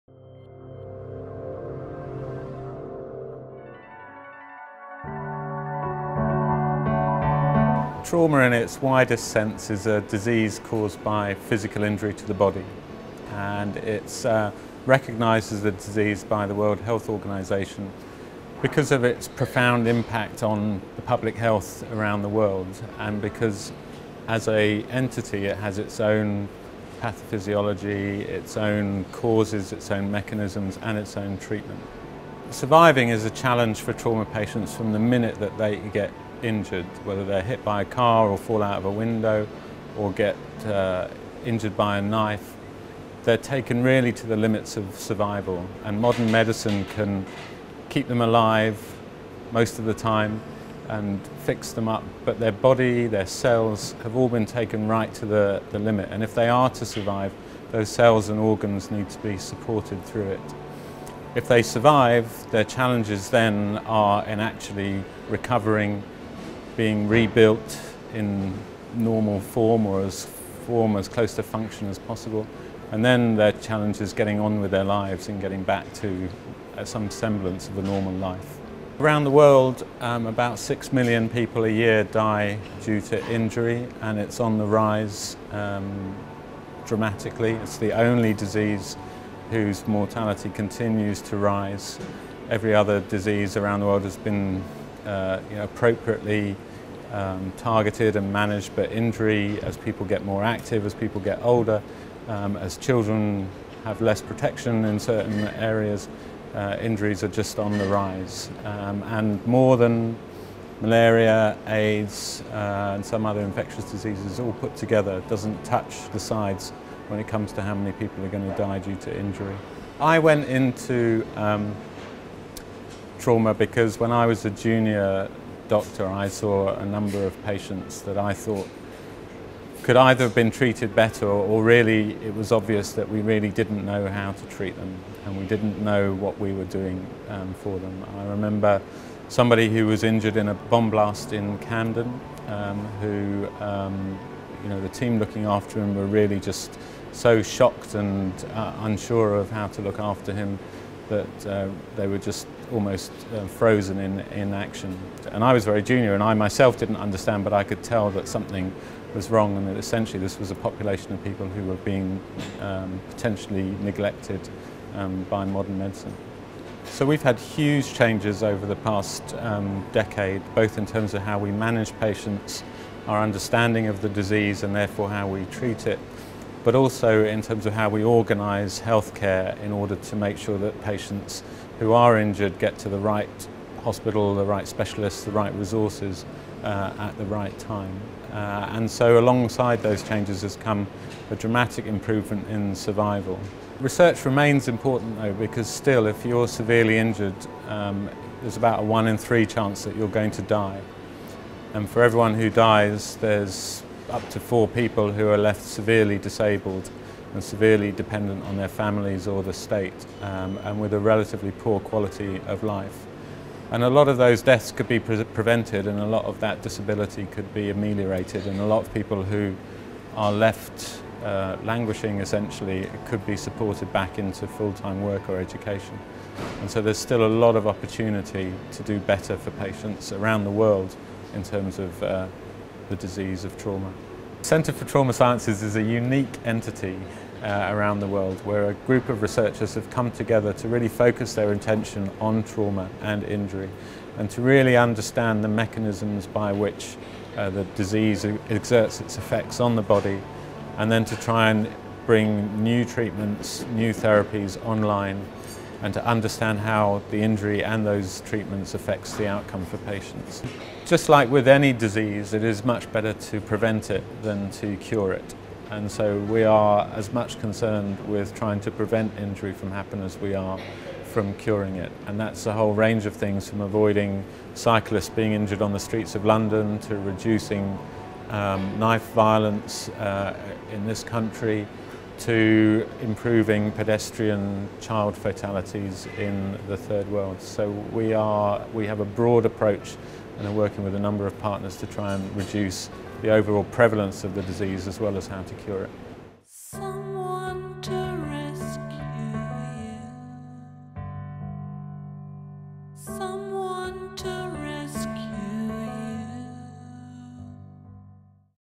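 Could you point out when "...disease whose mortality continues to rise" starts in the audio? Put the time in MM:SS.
01:28.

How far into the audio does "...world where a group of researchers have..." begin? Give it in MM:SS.
03:58.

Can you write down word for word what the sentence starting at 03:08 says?
Uh, and so alongside those changes has come a dramatic improvement in survival.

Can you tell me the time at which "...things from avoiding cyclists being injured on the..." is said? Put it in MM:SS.
04:33.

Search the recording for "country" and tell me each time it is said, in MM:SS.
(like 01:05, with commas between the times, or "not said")
04:41.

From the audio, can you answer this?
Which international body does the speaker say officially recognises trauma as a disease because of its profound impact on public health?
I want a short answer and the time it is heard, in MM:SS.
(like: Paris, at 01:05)
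World Health Organisation, at 00:16.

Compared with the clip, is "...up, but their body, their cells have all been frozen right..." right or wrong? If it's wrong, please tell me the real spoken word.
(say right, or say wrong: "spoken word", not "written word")
wrong: "taken", not "frozen".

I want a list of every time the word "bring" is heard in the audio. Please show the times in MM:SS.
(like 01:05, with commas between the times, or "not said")
04:12.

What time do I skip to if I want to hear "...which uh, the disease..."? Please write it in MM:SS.
04:06.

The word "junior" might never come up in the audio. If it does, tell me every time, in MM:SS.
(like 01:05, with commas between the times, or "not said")
02:04, 02:35.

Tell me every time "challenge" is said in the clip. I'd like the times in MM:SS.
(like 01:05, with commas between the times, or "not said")
00:33, 01:02, 01:13.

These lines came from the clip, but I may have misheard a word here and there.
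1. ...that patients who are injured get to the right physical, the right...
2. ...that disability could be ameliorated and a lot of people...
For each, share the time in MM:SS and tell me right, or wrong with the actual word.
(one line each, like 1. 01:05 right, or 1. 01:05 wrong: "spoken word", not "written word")
1. 03:00 wrong: "hospital", not "physical"
2. 03:36 right.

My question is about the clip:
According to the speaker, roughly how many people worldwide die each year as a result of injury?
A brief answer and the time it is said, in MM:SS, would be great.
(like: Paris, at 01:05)
6 million, at 01:20.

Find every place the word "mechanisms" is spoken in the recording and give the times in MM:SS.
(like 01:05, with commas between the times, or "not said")
00:30, 04:05.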